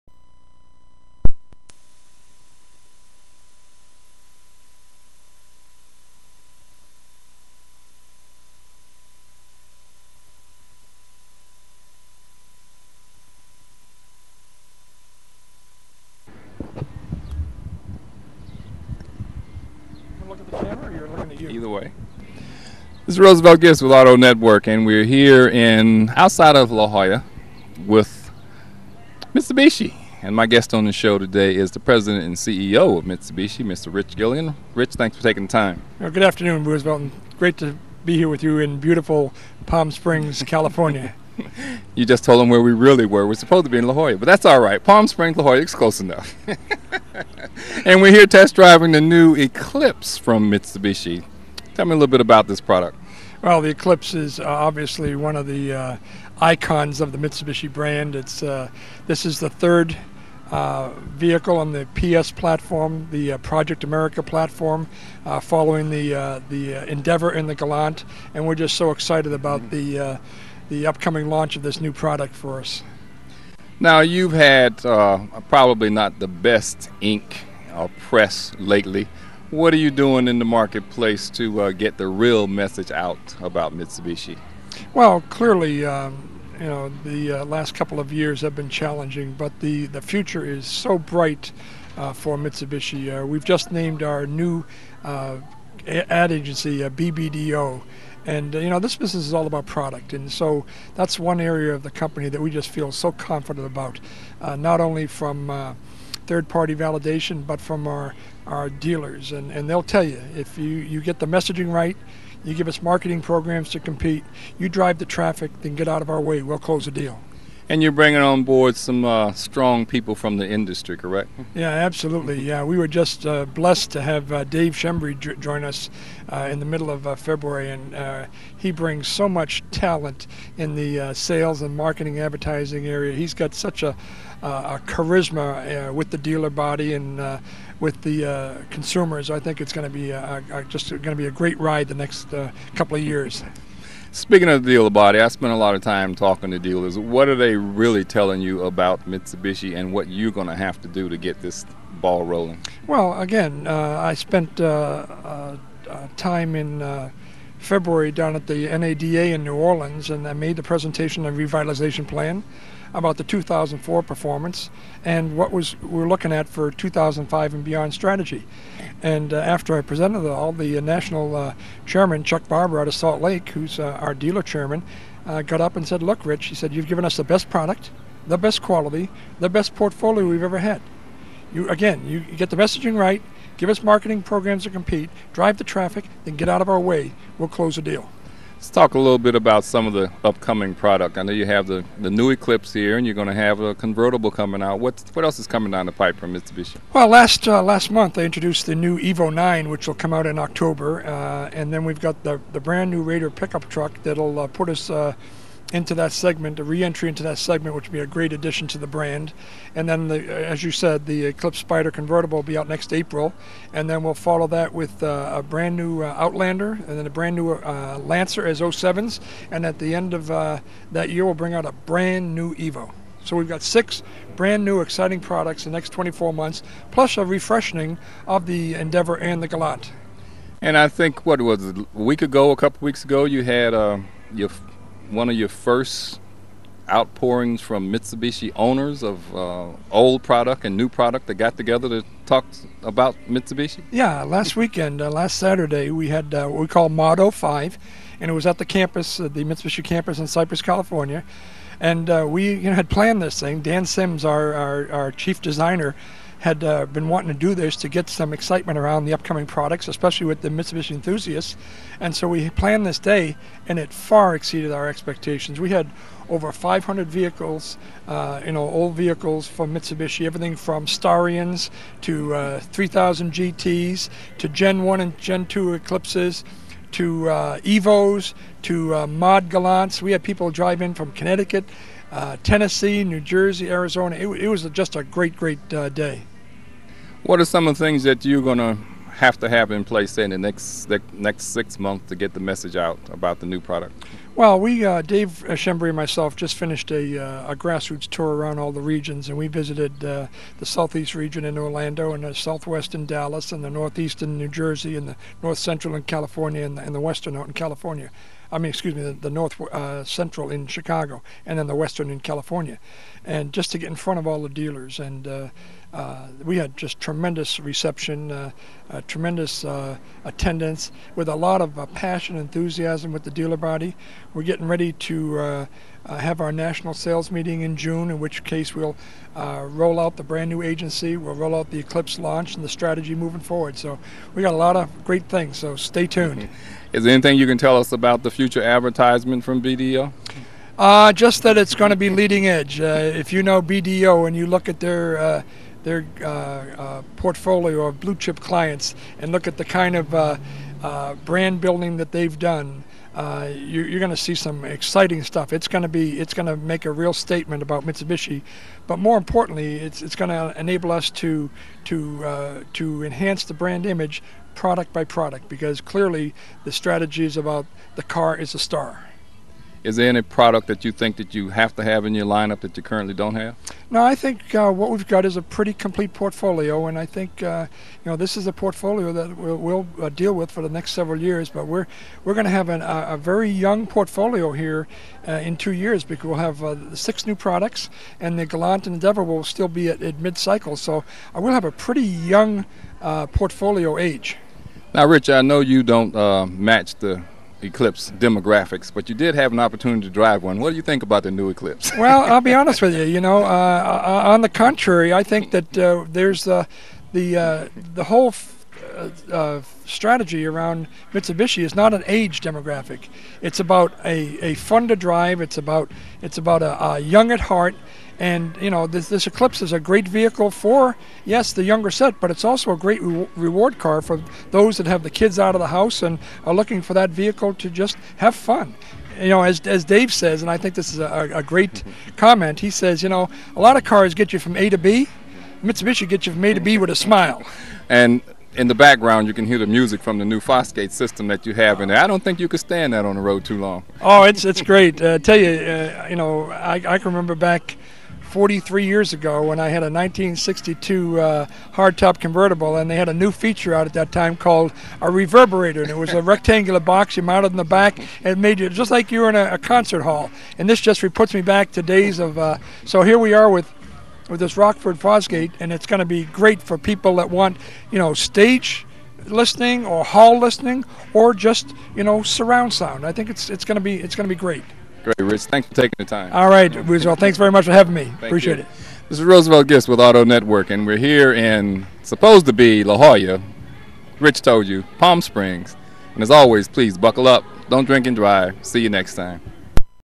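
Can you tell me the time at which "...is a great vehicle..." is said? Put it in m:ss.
6:59.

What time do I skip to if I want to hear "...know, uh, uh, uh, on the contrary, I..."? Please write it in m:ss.
6:43.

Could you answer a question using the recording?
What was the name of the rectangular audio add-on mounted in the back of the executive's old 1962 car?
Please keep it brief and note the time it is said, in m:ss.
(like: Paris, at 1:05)
reverberator, at 7:35.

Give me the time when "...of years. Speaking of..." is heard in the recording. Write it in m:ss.
2:22.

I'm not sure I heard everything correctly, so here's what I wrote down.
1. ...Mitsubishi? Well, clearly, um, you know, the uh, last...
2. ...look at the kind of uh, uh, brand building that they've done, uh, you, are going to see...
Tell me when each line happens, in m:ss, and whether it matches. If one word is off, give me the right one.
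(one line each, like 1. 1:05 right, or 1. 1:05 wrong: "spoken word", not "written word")
1. 1:23 right
2. 5:49 right.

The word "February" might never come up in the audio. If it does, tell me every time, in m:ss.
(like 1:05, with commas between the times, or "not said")
2:07, 2:37.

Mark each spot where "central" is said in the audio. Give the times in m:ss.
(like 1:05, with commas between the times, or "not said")
5:05, 5:10.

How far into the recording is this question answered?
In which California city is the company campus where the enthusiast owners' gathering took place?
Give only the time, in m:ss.
4:10.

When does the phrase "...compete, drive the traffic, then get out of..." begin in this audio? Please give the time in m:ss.
3:04.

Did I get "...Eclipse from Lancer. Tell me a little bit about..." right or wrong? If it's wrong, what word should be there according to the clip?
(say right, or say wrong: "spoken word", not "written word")
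wrong: "Mitsubishi", not "Lancer".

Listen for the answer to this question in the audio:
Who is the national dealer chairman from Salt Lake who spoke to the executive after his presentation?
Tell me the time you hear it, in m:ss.
2:52.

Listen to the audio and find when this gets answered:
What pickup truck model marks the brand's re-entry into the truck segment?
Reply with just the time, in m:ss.
3:23.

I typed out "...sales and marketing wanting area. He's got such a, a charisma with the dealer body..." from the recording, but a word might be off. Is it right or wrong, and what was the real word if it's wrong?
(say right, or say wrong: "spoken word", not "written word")
wrong: "advertising", not "wanting".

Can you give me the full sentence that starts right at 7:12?
comment, he says, you know, a lot of cars get you from A to B.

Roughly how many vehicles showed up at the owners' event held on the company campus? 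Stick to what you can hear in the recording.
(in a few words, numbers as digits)
500.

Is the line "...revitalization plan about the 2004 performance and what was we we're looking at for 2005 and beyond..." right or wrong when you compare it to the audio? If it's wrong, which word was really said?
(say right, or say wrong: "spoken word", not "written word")
right.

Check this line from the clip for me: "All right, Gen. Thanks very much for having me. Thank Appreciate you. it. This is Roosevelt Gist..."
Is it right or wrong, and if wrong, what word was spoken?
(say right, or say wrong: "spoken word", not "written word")
wrong: "Roosevelt", not "Gen".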